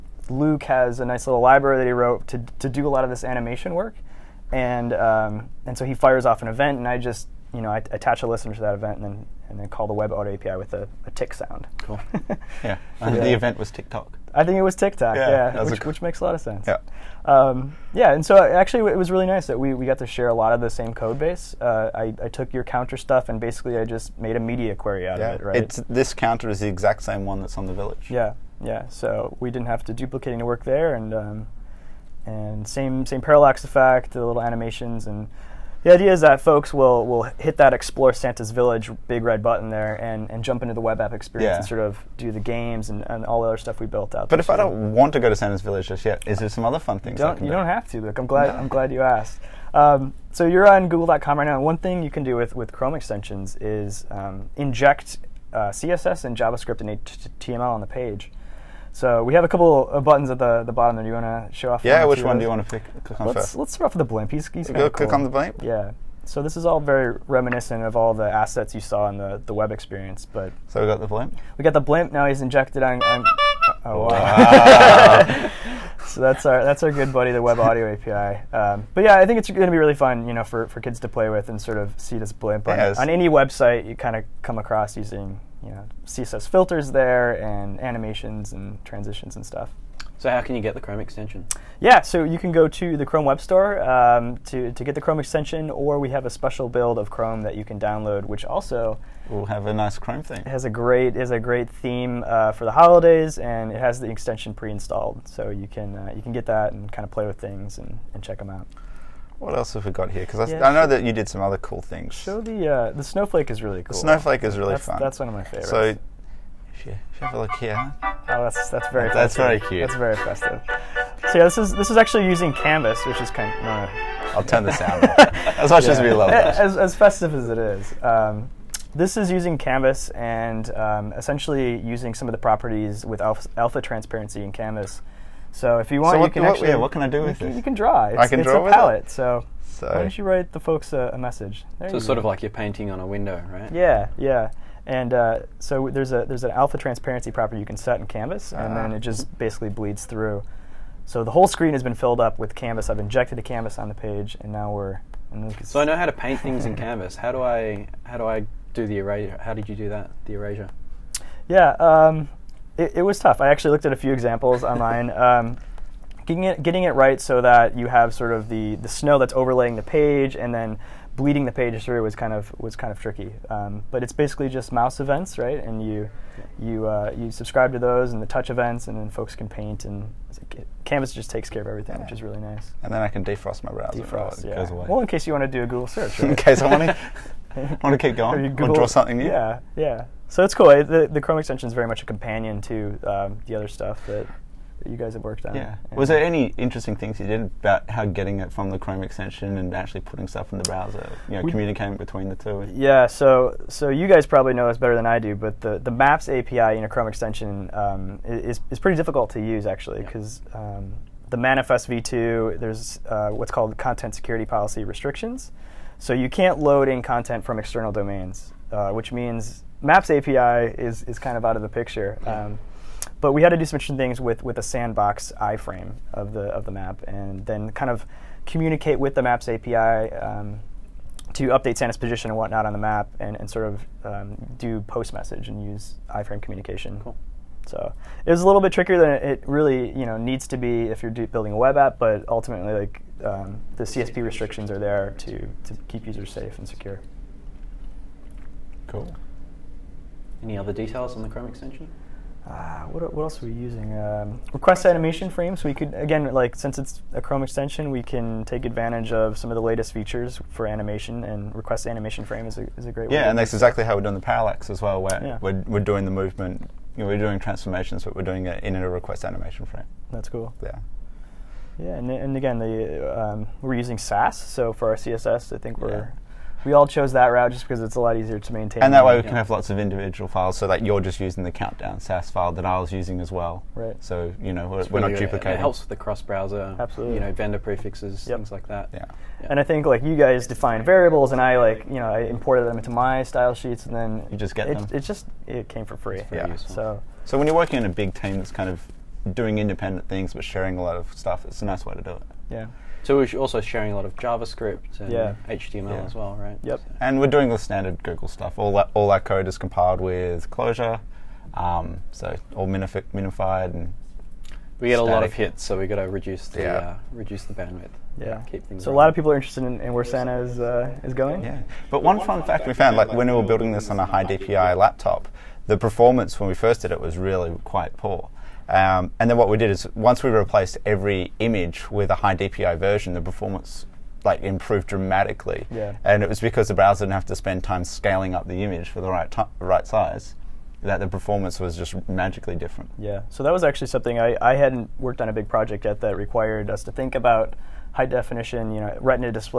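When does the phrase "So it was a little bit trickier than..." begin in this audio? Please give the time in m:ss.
3:57.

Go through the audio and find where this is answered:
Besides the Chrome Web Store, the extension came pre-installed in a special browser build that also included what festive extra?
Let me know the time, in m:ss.
1:39.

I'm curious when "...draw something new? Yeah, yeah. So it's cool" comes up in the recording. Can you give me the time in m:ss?
3:08.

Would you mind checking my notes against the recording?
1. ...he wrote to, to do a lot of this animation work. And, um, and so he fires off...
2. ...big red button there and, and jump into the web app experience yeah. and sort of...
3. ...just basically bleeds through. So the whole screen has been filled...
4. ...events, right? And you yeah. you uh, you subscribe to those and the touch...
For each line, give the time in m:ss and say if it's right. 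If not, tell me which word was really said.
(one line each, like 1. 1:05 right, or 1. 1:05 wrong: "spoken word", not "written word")
1. 0:01 right
2. 0:39 right
3. 2:29 right
4. 2:55 right.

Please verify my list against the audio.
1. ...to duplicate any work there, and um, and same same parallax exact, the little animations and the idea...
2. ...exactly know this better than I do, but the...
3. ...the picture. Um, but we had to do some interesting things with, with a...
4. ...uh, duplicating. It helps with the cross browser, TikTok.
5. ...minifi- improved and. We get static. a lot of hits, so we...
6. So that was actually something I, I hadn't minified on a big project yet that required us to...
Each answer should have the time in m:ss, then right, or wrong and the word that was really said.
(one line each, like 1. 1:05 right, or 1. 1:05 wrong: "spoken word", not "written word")
1. 0:29 wrong: "effect", not "exact"
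2. 3:24 wrong: "probably", not "exactly"
3. 3:41 right
4. 4:45 wrong: "Absolutely", not "TikTok"
5. 5:12 wrong: "minified", not "improved"
6. 5:43 wrong: "worked", not "minified".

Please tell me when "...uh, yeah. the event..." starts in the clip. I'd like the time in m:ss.
0:13.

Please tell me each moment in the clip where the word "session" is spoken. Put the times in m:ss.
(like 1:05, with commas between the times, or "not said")
not said.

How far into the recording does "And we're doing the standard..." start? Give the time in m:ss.
5:07.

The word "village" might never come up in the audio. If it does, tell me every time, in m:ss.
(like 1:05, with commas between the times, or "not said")
0:27, 0:38, 0:45.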